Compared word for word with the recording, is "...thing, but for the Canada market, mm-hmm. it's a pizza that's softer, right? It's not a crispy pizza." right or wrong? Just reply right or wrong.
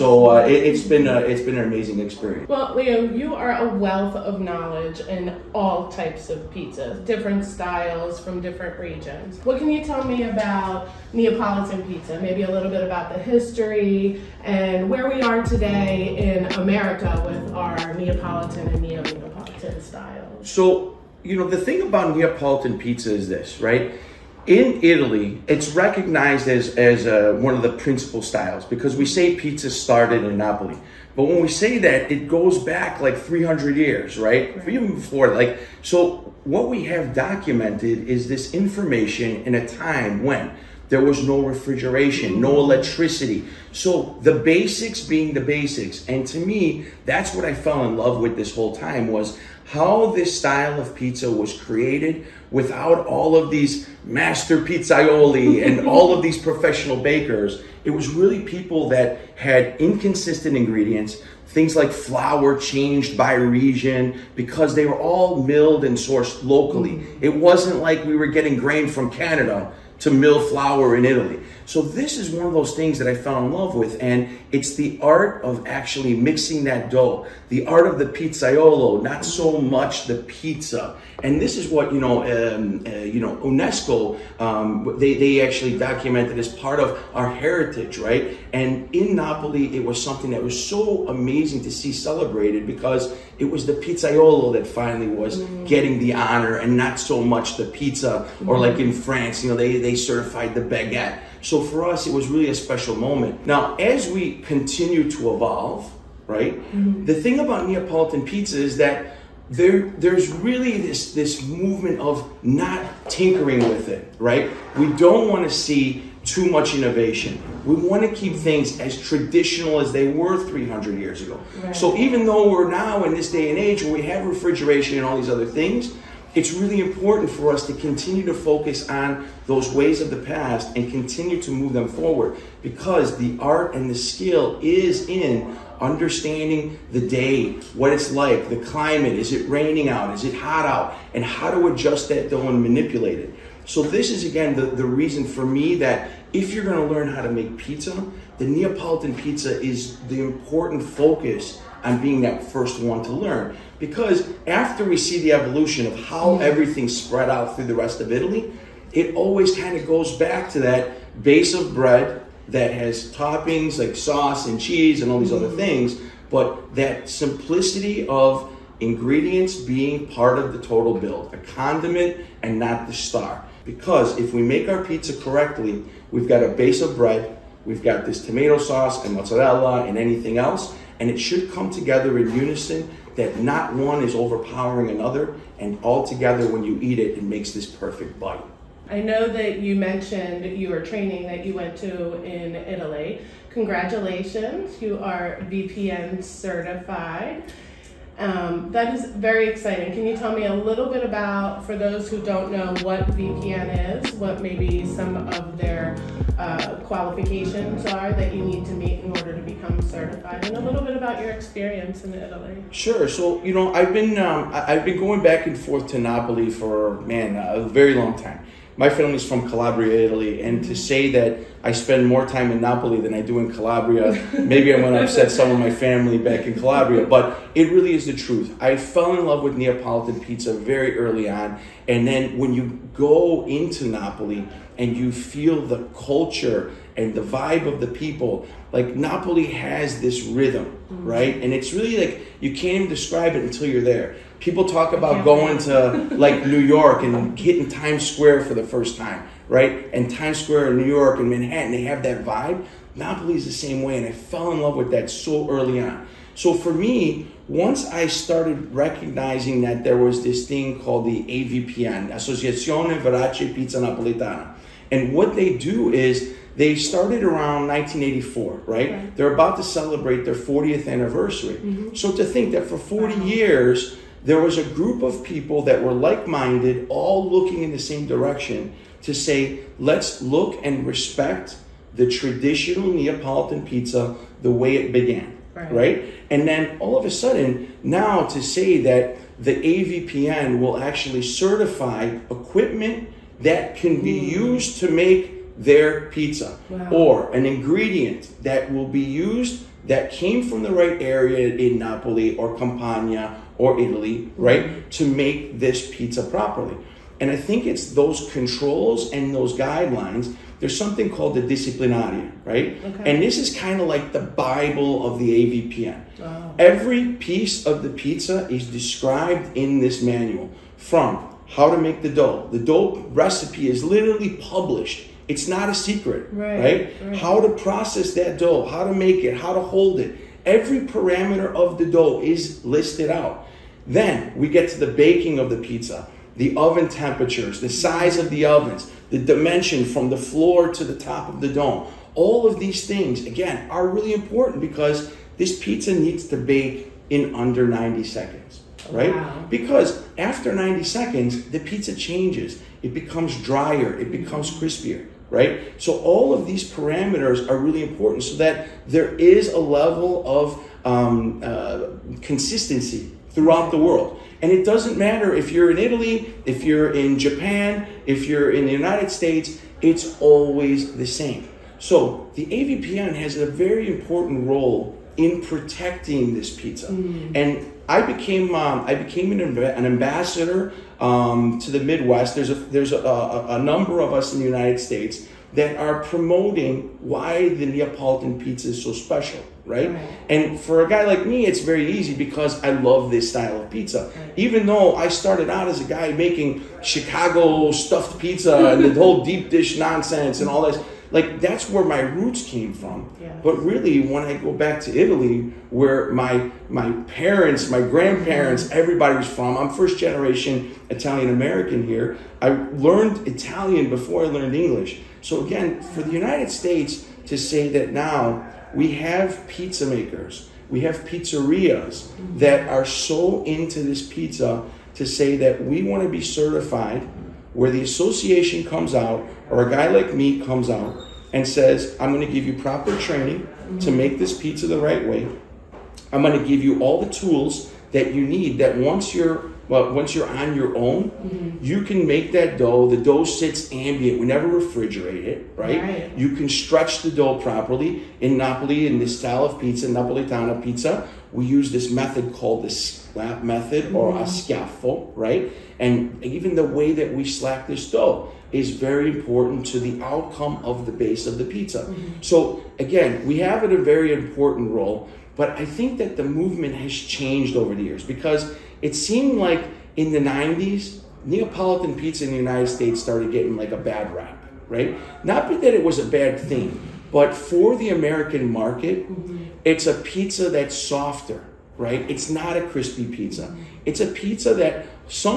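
wrong.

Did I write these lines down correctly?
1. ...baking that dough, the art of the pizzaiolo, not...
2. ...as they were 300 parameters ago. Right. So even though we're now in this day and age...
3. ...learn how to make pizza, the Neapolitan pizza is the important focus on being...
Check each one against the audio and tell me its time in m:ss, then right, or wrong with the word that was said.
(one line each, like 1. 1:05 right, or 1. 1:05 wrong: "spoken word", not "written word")
1. 1:16 wrong: "mixing", not "baking"
2. 1:59 wrong: "years", not "parameters"
3. 2:26 right.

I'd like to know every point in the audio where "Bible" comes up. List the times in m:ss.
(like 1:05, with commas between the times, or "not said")
5:14.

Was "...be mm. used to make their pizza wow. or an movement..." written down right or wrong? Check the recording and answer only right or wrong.
wrong.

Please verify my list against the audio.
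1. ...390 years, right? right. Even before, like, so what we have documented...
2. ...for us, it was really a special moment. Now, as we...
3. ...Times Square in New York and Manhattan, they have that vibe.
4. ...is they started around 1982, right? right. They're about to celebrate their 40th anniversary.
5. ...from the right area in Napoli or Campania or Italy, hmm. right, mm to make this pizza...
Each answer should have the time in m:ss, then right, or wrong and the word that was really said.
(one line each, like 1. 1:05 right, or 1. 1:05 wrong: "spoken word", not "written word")
1. 0:33 wrong: "300", not "390"
2. 1:41 right
3. 4:10 right
4. 4:25 wrong: "1984", not "1982"
5. 5:00 right.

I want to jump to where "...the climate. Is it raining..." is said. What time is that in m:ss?
2:18.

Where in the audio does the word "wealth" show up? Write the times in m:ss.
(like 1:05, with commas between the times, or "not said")
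0:03.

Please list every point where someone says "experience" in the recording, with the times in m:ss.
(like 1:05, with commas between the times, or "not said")
0:01, 3:31.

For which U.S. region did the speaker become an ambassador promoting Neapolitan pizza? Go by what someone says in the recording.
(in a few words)
the Midwest.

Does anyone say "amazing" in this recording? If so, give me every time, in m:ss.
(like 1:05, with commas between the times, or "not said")
0:01, 1:31.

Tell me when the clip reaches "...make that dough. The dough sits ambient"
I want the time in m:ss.
7:22.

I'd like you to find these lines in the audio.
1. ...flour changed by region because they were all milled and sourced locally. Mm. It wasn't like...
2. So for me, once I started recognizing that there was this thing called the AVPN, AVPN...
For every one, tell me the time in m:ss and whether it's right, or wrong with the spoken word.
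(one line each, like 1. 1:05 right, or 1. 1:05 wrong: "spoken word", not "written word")
1. 1:01 right
2. 4:16 wrong: "Associazione", not "AVPN".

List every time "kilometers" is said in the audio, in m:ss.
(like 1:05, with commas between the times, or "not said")
not said.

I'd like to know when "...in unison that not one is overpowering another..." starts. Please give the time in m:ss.
3:02.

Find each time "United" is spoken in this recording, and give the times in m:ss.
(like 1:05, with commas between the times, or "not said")
6:08, 6:24, 6:56, 7:52.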